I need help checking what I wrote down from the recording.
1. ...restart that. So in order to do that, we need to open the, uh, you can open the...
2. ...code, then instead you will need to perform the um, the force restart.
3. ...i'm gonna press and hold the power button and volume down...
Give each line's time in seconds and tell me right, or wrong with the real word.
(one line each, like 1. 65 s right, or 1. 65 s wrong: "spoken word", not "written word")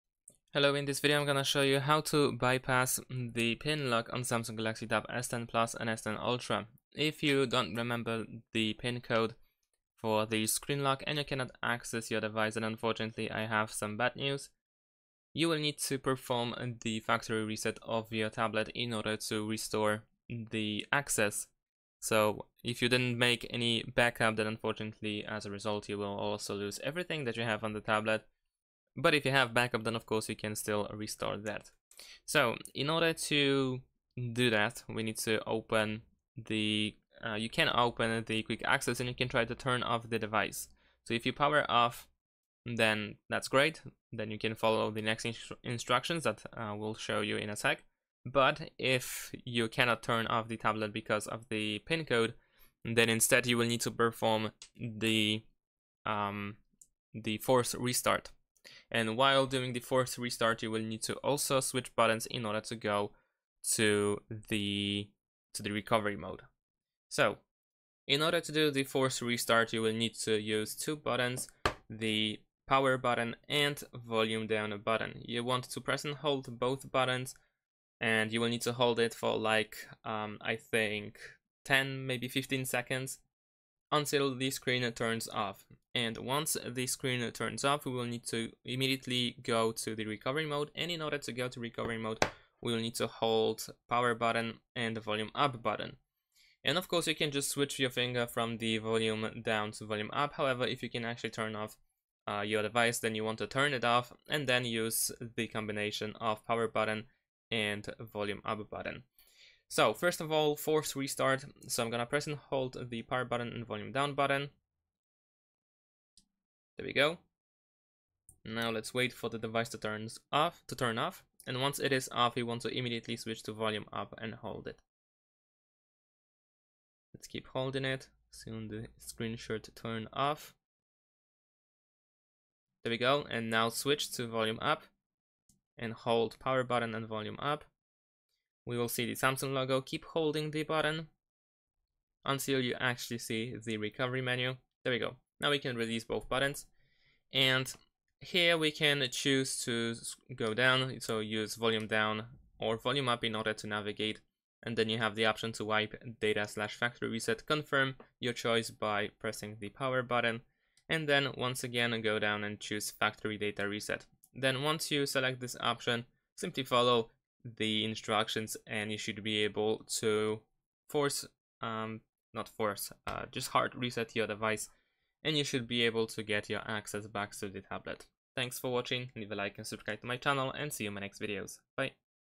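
1. 30 s right
2. 52 s right
3. 111 s right.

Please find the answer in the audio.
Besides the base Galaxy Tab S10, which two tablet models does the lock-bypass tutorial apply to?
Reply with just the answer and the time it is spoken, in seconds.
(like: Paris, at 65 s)
S10 Plus and S10 Ultra, at 5 s.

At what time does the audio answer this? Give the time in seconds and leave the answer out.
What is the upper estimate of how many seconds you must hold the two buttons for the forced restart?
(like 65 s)
82 s.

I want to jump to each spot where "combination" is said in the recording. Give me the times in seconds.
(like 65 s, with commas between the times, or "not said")
105 s.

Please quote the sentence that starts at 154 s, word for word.
And then you have the option to wipe data slash factory reset, confirm your choice by pressing the power button.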